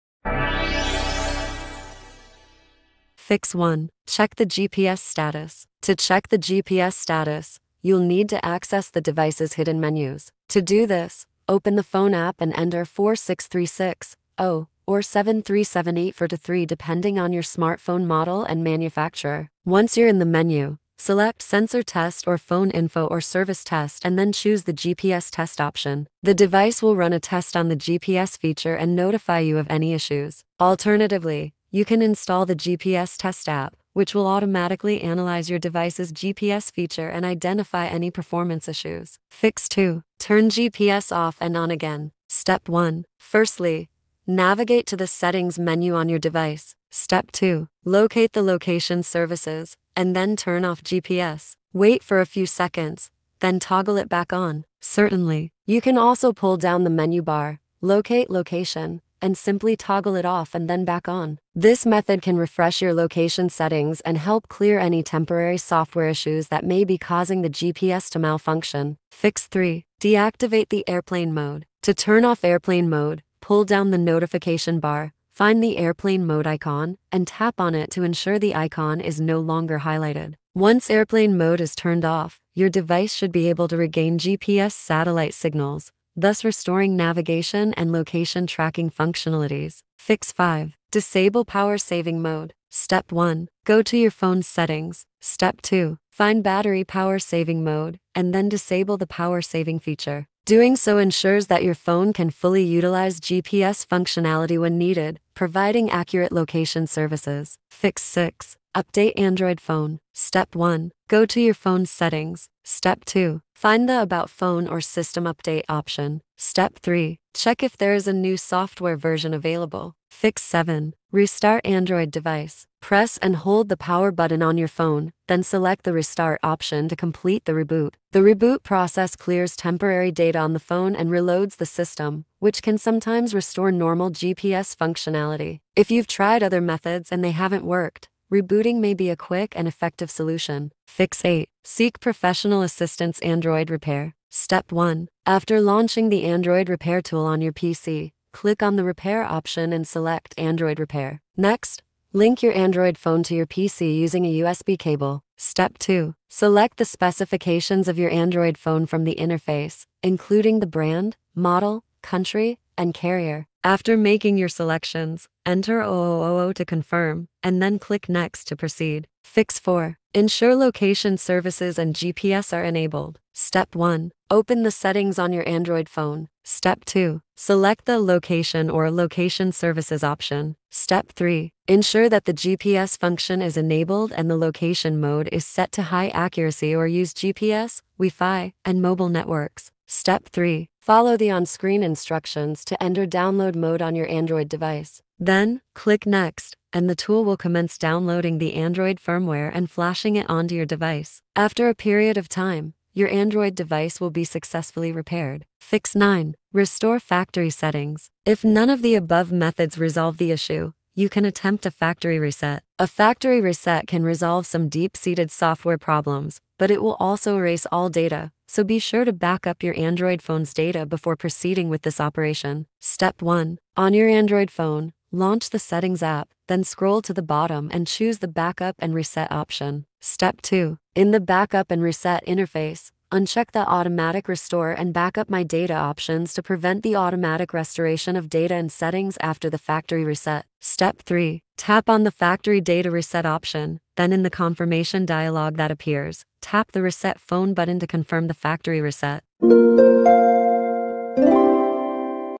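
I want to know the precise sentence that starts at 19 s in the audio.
Once you're in the menu, select sensor test or phone info or service test and then choose the GPS test option.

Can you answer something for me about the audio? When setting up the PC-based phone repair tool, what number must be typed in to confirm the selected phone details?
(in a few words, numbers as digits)
000.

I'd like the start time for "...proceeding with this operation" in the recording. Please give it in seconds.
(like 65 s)
221 s.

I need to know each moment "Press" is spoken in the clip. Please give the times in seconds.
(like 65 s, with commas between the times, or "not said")
122 s.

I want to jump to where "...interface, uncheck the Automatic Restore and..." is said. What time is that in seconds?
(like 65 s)
232 s.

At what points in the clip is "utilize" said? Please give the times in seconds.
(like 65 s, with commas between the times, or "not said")
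102 s.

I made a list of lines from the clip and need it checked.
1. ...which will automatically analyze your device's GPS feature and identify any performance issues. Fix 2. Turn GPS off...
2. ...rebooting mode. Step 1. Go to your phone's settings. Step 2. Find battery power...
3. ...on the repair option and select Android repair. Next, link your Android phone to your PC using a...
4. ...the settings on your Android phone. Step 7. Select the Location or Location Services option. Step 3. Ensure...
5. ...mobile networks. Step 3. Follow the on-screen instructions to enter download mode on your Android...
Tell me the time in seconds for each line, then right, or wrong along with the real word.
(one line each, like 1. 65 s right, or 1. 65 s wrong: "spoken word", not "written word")
1. 33 s right
2. 91 s wrong: "saving", not "rebooting"
3. 148 s right
4. 174 s wrong: "2", not "7"
5. 188 s right.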